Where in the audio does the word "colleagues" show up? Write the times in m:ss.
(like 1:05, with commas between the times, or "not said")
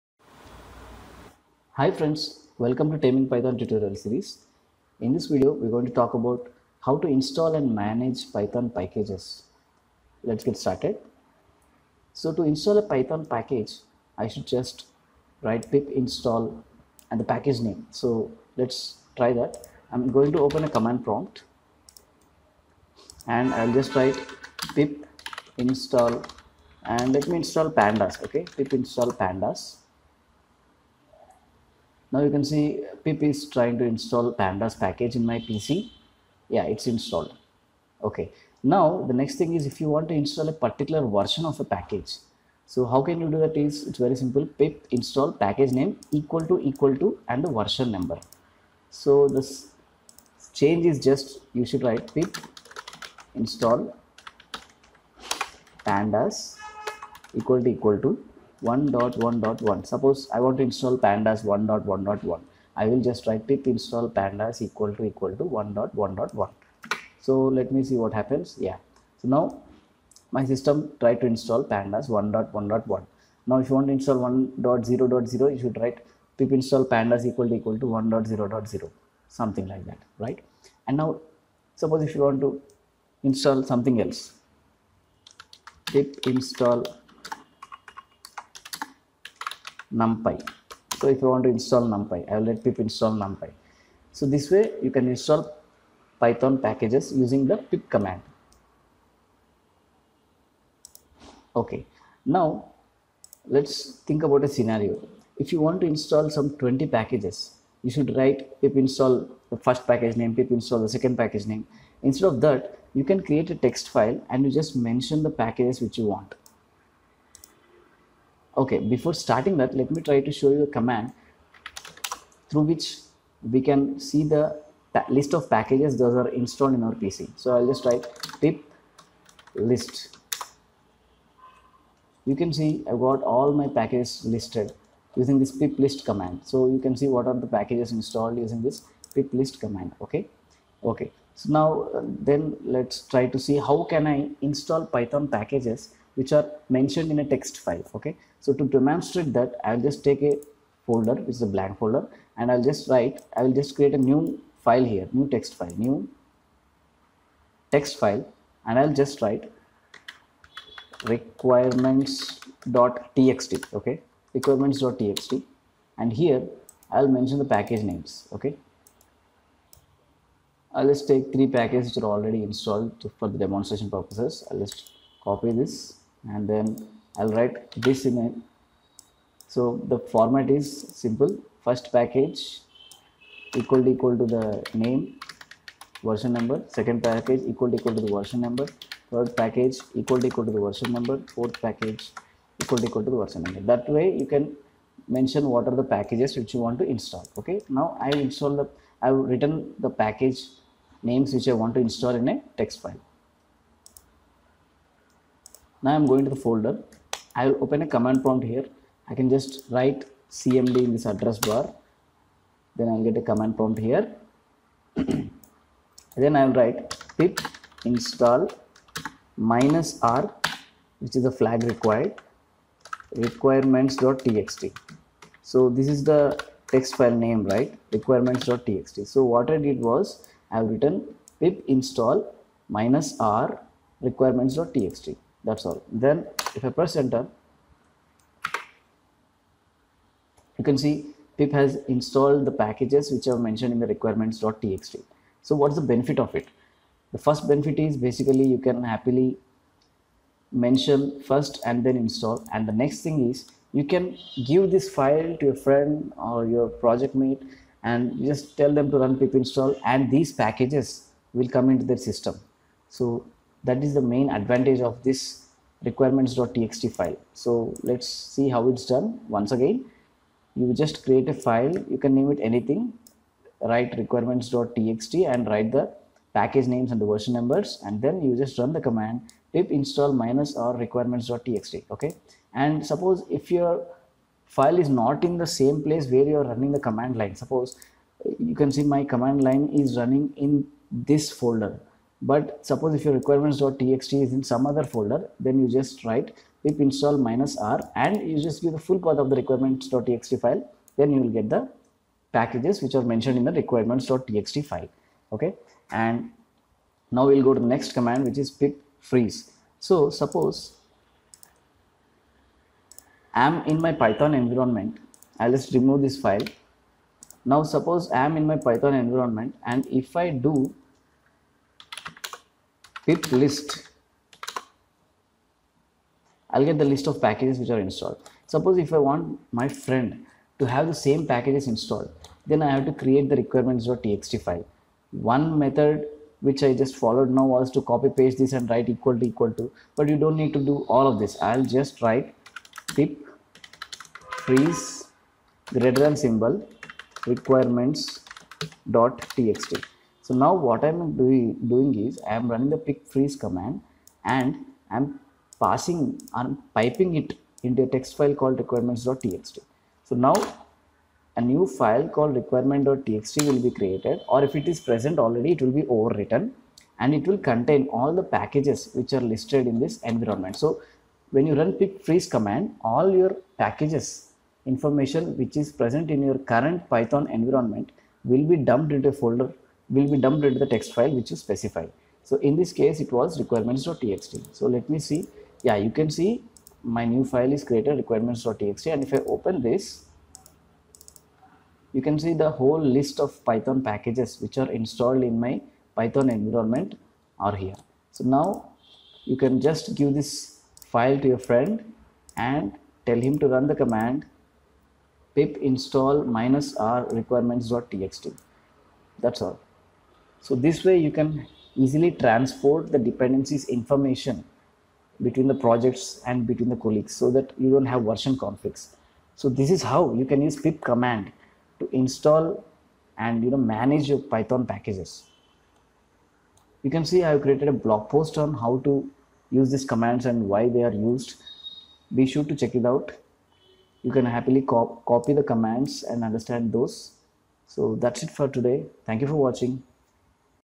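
6:56.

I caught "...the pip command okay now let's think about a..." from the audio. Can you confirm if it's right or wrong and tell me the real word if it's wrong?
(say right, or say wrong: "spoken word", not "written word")
right.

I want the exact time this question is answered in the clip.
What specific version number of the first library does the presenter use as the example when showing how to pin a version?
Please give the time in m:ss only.
0:55.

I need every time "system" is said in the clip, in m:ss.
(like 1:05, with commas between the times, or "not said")
1:10, 4:22.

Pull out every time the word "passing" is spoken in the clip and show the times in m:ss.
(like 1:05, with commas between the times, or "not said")
5:55.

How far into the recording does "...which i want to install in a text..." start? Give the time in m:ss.
3:21.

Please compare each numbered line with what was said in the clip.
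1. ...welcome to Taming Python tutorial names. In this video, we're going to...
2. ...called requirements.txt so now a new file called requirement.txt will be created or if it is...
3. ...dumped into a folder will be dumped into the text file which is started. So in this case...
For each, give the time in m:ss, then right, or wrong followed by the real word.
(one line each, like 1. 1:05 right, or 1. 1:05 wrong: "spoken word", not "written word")
1. 0:02 wrong: "series", not "names"
2. 5:58 right
3. 6:18 wrong: "specified", not "started".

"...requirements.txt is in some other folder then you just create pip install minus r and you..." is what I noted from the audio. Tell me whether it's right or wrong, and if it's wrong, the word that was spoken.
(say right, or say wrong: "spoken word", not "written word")
wrong: "write", not "create".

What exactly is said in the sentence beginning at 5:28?
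Suppose if I want my friend to have the same packages installed, then I have to create the requirements.txt file.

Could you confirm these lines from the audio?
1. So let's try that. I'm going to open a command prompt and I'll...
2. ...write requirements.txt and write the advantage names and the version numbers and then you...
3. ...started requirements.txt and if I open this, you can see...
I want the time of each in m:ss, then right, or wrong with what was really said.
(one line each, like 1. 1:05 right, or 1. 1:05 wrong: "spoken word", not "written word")
1. 0:17 right
2. 4:33 wrong: "package", not "advantage"
3. 6:27 wrong: "created", not "started".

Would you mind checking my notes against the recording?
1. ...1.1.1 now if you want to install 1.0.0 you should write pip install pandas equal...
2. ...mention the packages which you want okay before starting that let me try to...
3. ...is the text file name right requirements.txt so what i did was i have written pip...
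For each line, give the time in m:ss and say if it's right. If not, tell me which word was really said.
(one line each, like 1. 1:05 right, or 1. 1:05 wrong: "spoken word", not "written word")
1. 1:12 right
2. 1:54 right
3. 3:45 right.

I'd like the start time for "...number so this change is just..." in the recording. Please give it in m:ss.
0:47.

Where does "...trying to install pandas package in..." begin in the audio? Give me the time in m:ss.
0:33.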